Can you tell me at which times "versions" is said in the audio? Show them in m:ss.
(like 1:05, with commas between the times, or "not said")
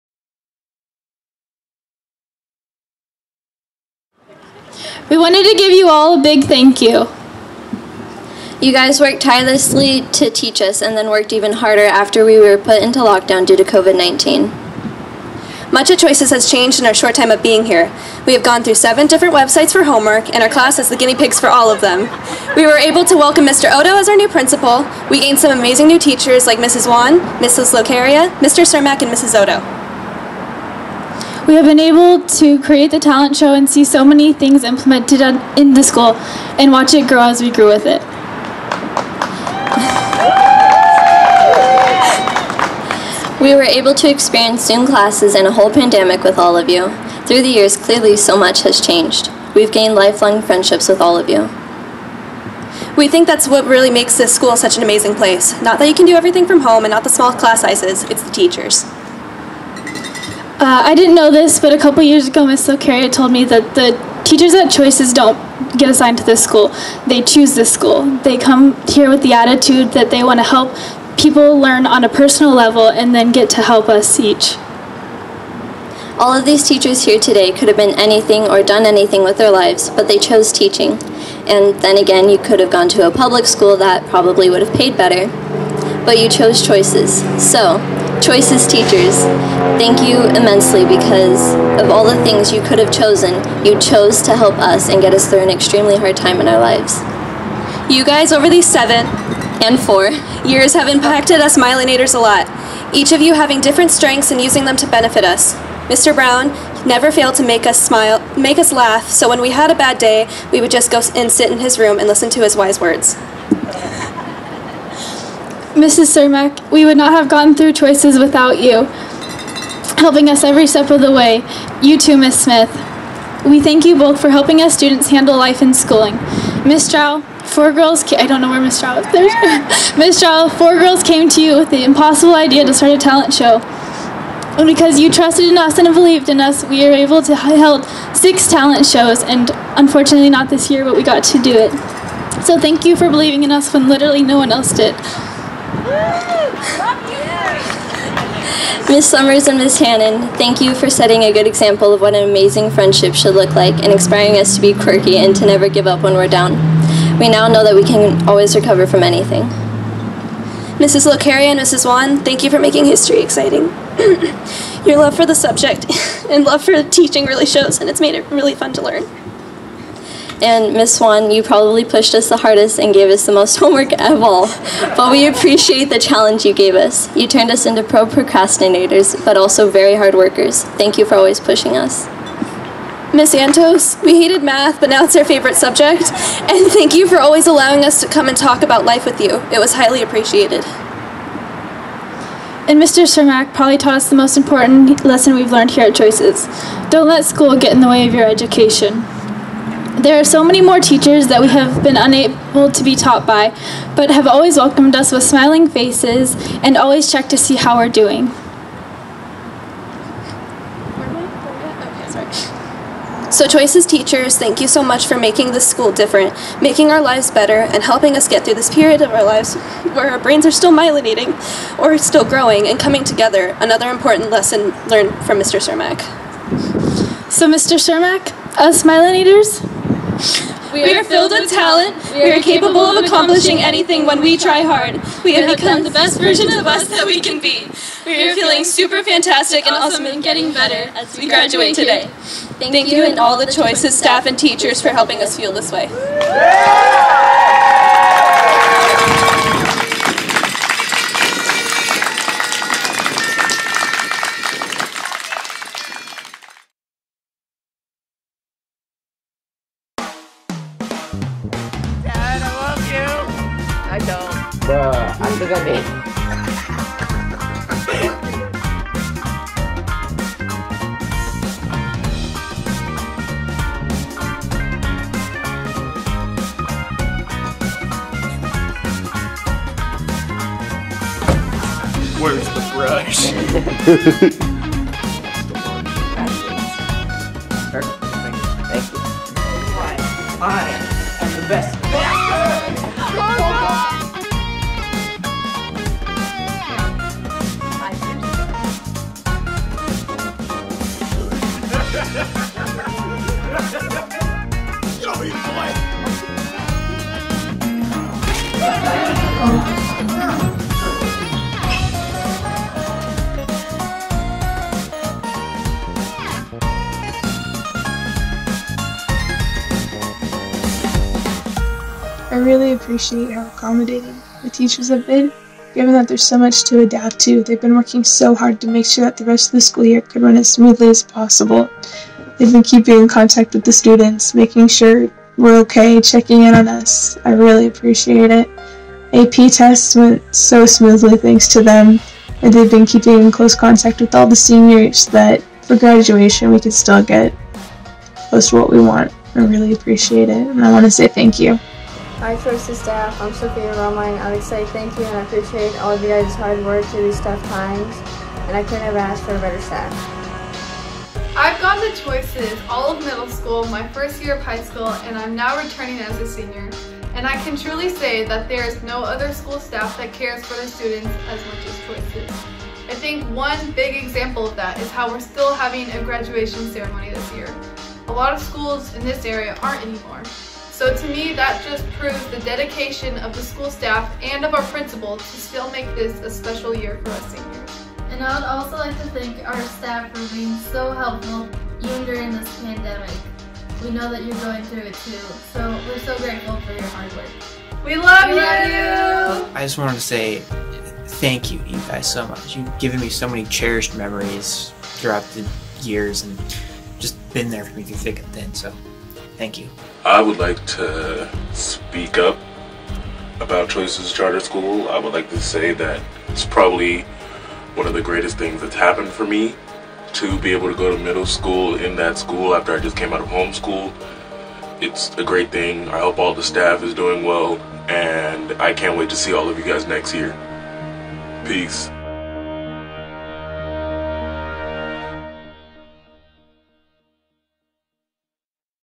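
3:56.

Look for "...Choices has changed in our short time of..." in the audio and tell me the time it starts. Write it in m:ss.
0:15.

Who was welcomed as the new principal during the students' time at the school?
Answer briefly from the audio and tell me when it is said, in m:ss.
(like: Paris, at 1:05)
Mr. Odo, at 0:23.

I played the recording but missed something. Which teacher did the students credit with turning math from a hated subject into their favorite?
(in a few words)
Miss Antos.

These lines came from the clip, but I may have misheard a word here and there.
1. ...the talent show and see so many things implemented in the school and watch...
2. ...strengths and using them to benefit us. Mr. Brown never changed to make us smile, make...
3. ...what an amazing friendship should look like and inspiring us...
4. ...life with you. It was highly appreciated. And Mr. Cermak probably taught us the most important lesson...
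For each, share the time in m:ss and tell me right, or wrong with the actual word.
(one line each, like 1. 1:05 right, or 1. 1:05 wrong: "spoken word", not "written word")
1. 0:32 right
2. 1:43 wrong: "failed", not "changed"
3. 2:32 right
4. 3:08 right.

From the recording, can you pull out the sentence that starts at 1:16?
All of these teachers here today could have been anything or done anything with their lives, but they chose teaching.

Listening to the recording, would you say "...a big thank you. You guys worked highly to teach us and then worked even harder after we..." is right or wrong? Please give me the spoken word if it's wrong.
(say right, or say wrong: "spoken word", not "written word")
wrong: "tirelessly", not "highly".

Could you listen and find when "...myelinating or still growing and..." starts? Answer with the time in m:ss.
3:40.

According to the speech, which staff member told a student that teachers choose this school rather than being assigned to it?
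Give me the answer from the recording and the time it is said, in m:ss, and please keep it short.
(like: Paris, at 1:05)
Ms. Silcaria, at 1:02.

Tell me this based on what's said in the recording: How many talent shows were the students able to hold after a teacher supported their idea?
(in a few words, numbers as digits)
6.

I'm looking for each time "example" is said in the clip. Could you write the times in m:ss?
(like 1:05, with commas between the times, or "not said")
2:31, 6:13.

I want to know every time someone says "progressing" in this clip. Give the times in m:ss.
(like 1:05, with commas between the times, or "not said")
not said.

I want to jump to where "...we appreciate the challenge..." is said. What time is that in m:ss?
2:55.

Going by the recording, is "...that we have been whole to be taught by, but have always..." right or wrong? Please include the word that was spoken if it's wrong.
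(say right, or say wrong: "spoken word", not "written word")
wrong: "unable", not "whole".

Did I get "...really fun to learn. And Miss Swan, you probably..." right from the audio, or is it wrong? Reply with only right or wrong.
right.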